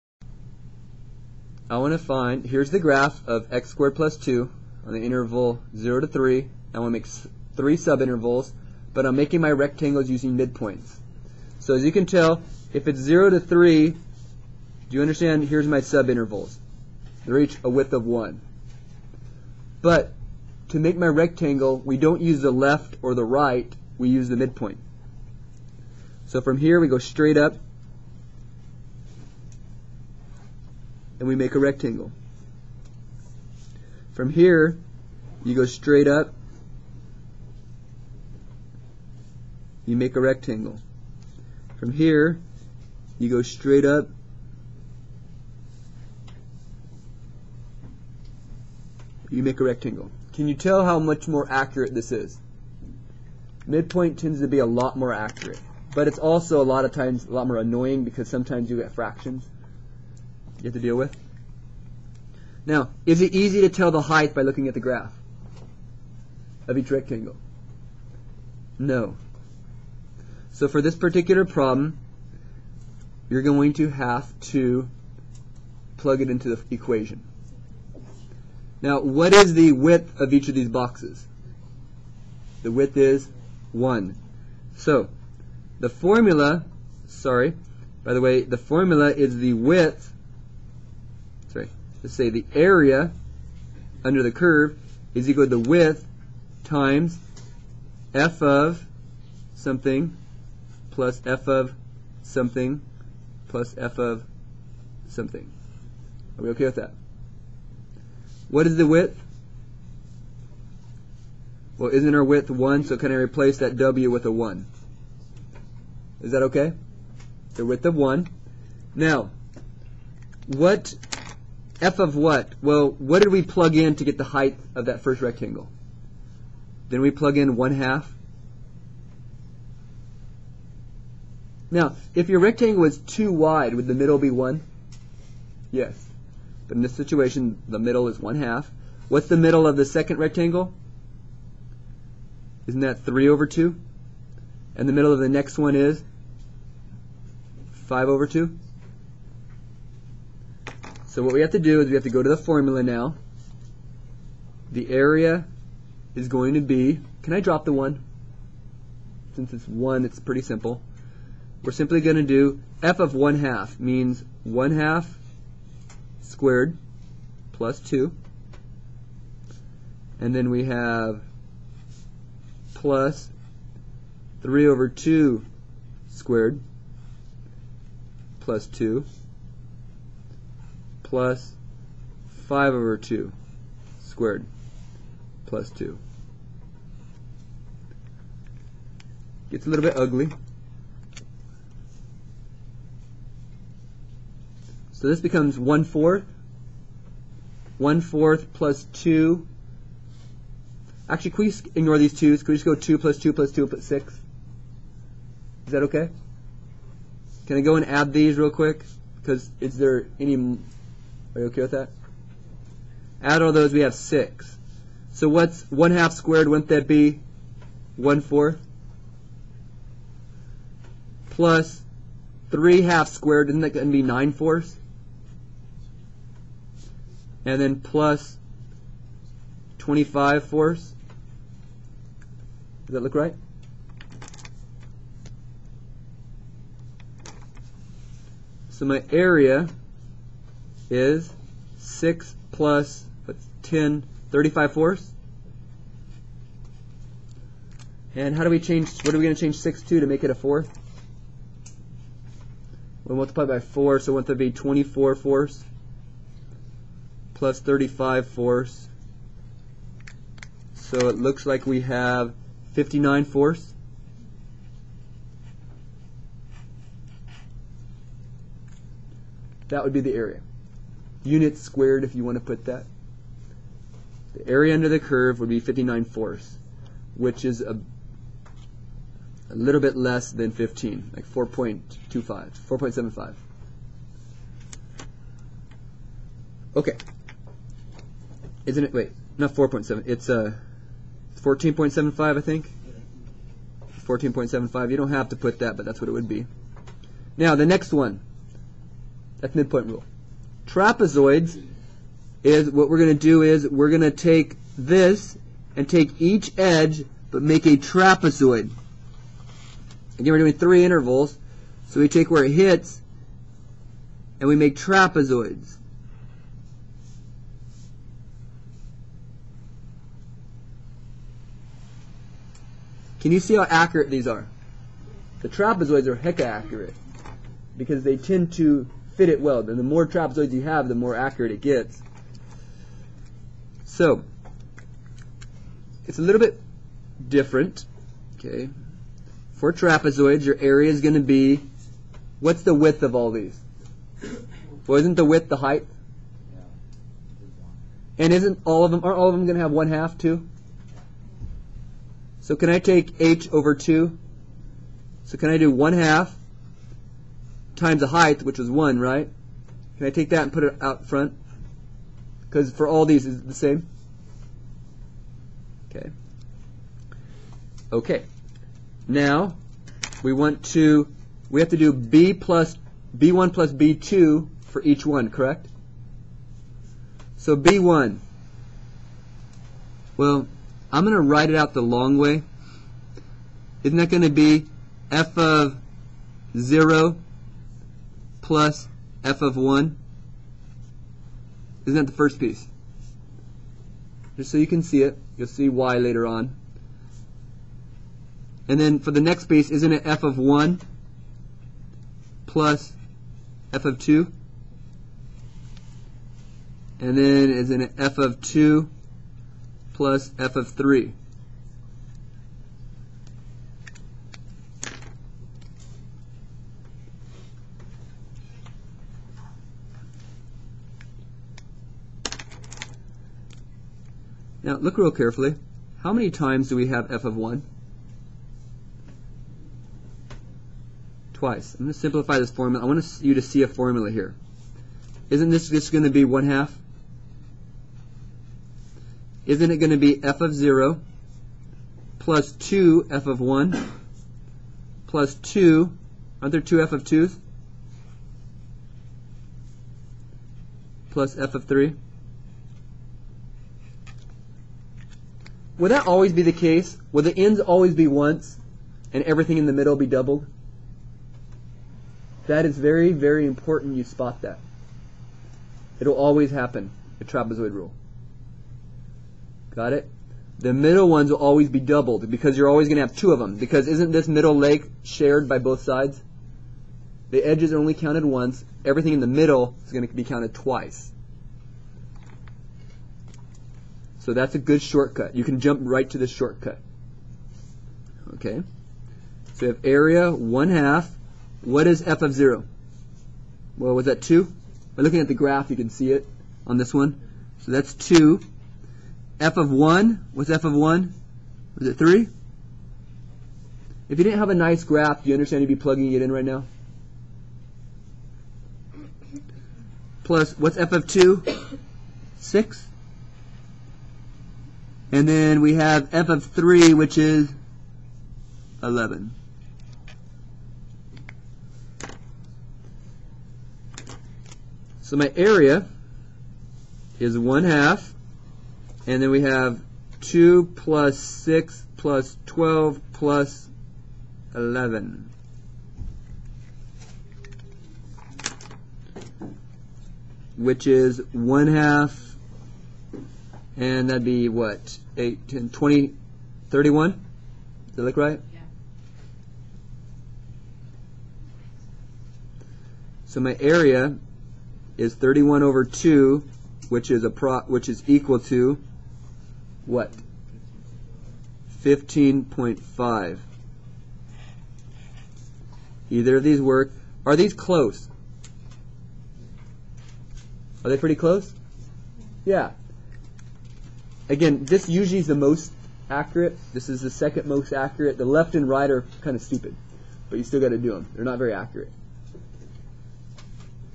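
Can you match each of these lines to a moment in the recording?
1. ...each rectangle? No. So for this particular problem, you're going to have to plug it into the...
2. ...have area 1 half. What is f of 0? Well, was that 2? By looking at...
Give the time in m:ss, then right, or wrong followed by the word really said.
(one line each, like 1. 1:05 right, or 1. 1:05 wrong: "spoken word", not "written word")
1. 1:06 right
2. 8:09 right.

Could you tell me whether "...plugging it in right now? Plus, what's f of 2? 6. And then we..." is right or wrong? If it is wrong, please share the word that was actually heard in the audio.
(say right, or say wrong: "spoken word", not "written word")
right.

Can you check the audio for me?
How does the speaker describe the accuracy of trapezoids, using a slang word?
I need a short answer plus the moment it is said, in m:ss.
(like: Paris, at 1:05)
hecka accurate, at 5:26.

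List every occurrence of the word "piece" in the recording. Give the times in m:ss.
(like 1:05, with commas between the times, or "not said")
6:32, 6:39.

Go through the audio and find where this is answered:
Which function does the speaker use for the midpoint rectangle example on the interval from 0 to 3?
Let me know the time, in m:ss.
0:03.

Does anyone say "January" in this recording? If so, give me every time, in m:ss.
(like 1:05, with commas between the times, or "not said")
not said.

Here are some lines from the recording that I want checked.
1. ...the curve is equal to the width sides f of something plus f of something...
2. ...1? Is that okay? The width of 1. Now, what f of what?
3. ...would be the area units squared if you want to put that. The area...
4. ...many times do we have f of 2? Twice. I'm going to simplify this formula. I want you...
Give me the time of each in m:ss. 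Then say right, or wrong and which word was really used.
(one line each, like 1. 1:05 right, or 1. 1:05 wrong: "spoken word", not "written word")
1. 1:34 wrong: "times", not "sides"
2. 1:54 right
3. 4:29 right
4. 7:06 wrong: "1", not "2".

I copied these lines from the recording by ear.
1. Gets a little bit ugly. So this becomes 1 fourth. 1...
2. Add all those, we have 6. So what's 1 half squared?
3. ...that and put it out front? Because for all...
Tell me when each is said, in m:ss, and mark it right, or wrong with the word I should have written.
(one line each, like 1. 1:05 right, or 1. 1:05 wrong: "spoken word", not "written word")
1. 3:09 right
2. 3:33 right
3. 6:00 right.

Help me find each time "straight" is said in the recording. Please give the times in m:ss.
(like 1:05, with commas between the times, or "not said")
0:26, 0:35, 0:43.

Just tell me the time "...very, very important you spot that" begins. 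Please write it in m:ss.
7:42.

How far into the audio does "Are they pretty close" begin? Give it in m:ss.
9:30.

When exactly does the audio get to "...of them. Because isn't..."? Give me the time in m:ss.
7:53.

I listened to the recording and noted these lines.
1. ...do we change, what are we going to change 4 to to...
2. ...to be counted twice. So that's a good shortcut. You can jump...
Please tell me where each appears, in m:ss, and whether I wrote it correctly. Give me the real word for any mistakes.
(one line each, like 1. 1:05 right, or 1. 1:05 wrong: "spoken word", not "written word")
1. 4:08 wrong: "6", not "4"
2. 8:00 right.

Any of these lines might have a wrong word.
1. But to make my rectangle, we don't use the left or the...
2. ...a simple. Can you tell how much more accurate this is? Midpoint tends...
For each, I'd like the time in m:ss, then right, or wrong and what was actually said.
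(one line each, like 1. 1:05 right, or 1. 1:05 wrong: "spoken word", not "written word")
1. 0:19 right
2. 0:49 wrong: "rectangle", not "simple".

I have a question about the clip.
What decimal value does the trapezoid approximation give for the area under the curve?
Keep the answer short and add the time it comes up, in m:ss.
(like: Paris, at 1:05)
15.5, at 9:21.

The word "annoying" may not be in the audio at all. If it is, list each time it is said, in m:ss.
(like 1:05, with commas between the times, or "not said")
0:57.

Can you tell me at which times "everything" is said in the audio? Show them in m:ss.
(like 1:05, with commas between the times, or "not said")
7:39, 7:58.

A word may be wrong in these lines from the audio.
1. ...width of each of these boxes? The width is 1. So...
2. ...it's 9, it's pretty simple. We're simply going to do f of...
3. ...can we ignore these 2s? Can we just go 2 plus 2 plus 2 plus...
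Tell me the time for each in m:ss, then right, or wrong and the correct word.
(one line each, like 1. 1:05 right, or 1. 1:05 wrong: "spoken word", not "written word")
1. 1:19 right
2. 2:39 wrong: "1", not "9"
3. 3:21 right.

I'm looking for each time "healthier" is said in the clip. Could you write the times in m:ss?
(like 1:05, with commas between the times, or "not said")
not said.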